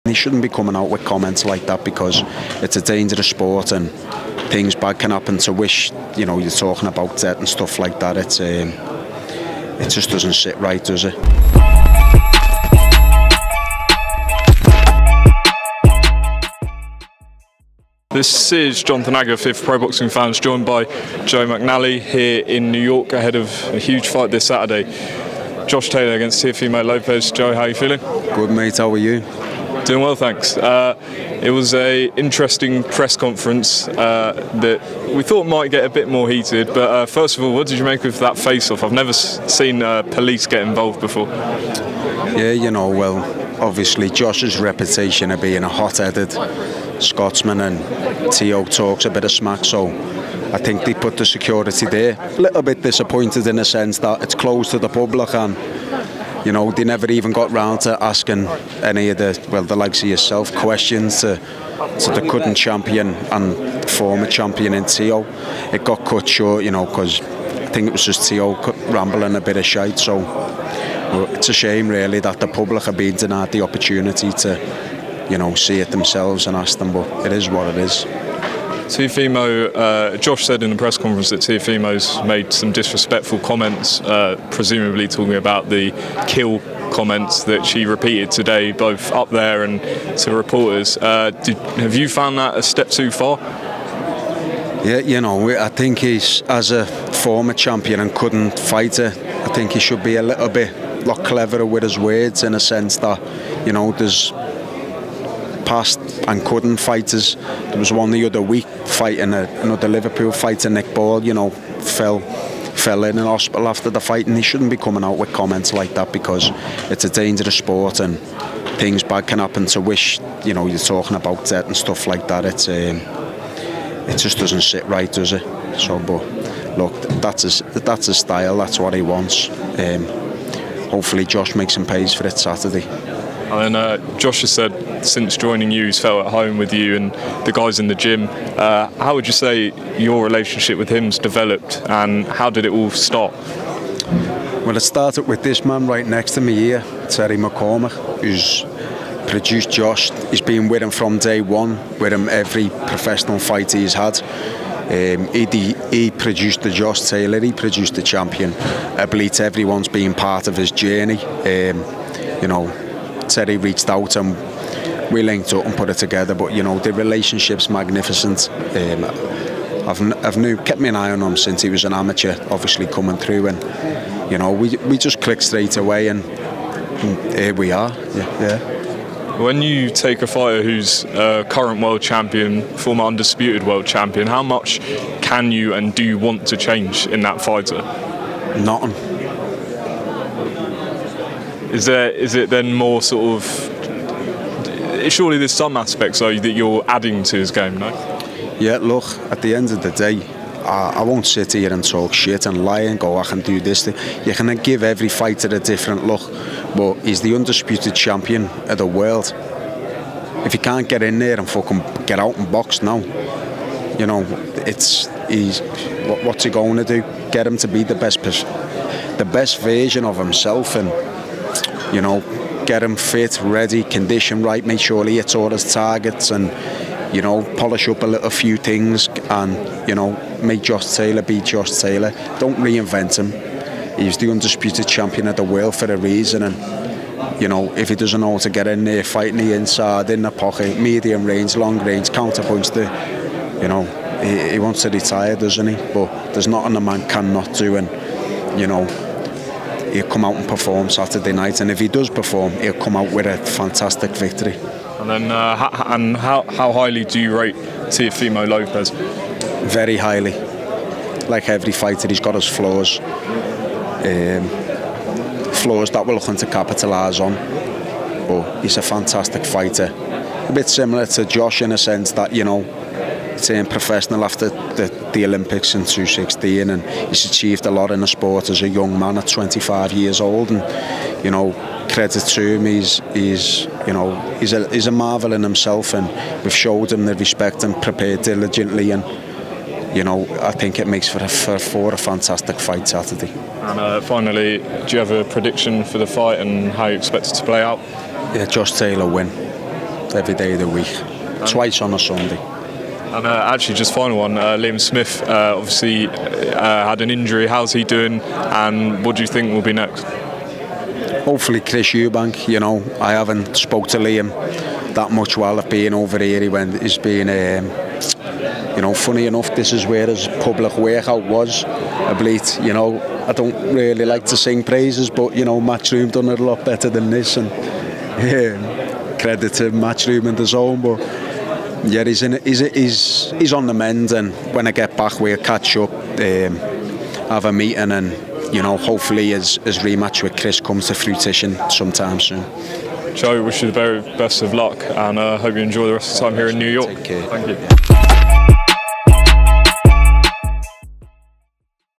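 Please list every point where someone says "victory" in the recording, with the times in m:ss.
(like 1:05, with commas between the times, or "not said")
4:14.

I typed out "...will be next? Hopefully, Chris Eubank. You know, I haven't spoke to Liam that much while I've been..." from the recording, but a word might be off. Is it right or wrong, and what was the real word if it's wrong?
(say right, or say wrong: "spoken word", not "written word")
right.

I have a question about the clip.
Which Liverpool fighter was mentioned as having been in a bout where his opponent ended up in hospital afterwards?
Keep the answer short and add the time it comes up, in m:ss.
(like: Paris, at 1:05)
Nick Ball, at 1:50.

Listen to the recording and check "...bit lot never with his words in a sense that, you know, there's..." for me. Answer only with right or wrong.
wrong.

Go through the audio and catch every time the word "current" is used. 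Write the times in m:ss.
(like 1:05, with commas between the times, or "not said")
1:02, 3:01.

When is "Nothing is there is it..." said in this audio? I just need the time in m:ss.
3:08.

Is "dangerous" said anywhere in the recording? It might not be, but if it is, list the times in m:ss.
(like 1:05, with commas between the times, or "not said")
0:02, 1:57.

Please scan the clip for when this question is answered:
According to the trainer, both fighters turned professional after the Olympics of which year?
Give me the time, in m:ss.
4:35.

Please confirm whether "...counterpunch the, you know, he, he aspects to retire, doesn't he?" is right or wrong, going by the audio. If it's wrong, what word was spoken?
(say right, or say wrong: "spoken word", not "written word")
wrong: "wants", not "aspects".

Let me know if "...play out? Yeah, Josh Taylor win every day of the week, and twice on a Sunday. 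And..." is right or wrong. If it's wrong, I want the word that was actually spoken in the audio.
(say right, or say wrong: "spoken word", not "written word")
right.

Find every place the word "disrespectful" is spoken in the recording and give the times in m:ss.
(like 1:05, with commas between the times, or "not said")
1:22.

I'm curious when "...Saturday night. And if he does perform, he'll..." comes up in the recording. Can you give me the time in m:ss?
4:10.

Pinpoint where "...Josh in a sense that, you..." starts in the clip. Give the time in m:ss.
4:31.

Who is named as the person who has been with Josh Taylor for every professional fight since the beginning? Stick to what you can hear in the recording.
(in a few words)
Terry McCormack.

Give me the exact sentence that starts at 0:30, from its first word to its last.
Uh, it was a interesting press conference uh, that we thought might get a bit more heated.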